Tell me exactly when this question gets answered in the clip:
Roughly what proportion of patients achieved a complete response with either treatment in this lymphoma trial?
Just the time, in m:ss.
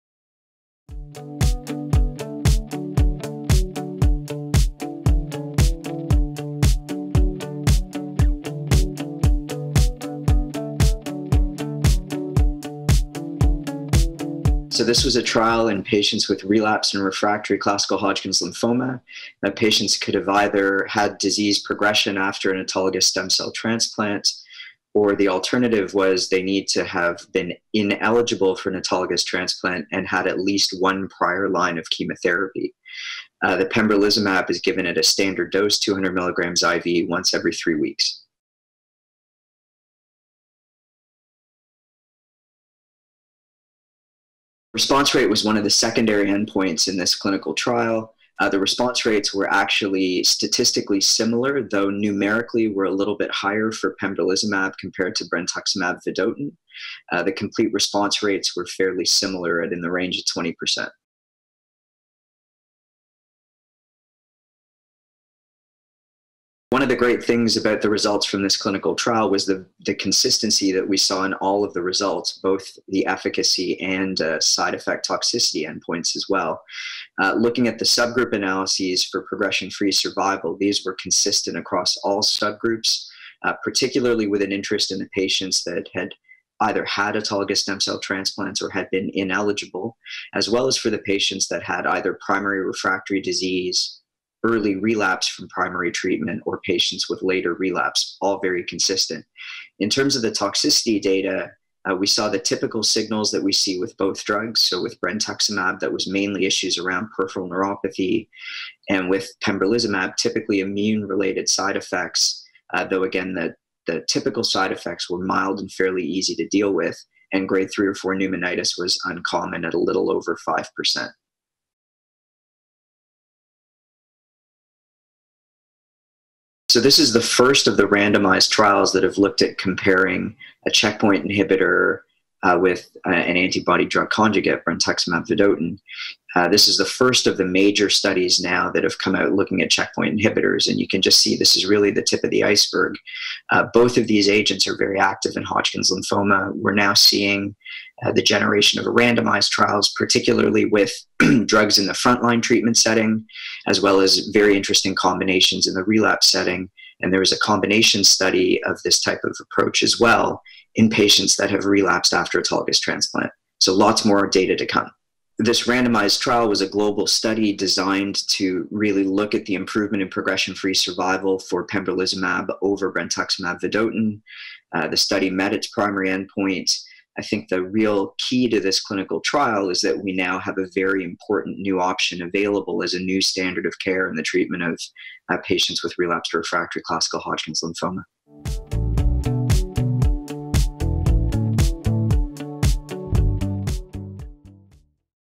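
1:00.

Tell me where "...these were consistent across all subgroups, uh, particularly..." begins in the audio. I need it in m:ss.
1:20.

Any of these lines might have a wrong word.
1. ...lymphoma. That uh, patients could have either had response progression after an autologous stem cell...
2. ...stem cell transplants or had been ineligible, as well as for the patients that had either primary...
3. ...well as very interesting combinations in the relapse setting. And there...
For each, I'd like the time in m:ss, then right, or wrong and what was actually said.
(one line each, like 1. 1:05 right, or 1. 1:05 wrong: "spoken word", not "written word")
1. 0:18 wrong: "disease", not "response"
2. 1:27 right
3. 2:33 right.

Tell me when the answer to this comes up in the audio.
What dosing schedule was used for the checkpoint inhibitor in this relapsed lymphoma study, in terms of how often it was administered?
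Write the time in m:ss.
0:37.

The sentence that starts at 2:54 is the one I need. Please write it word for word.
Uh, the study met its primary endpoint.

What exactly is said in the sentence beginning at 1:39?
In terms of the toxicity data, uh, we saw the typical signals that we see with both drugs.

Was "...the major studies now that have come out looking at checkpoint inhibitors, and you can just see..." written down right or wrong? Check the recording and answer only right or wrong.
right.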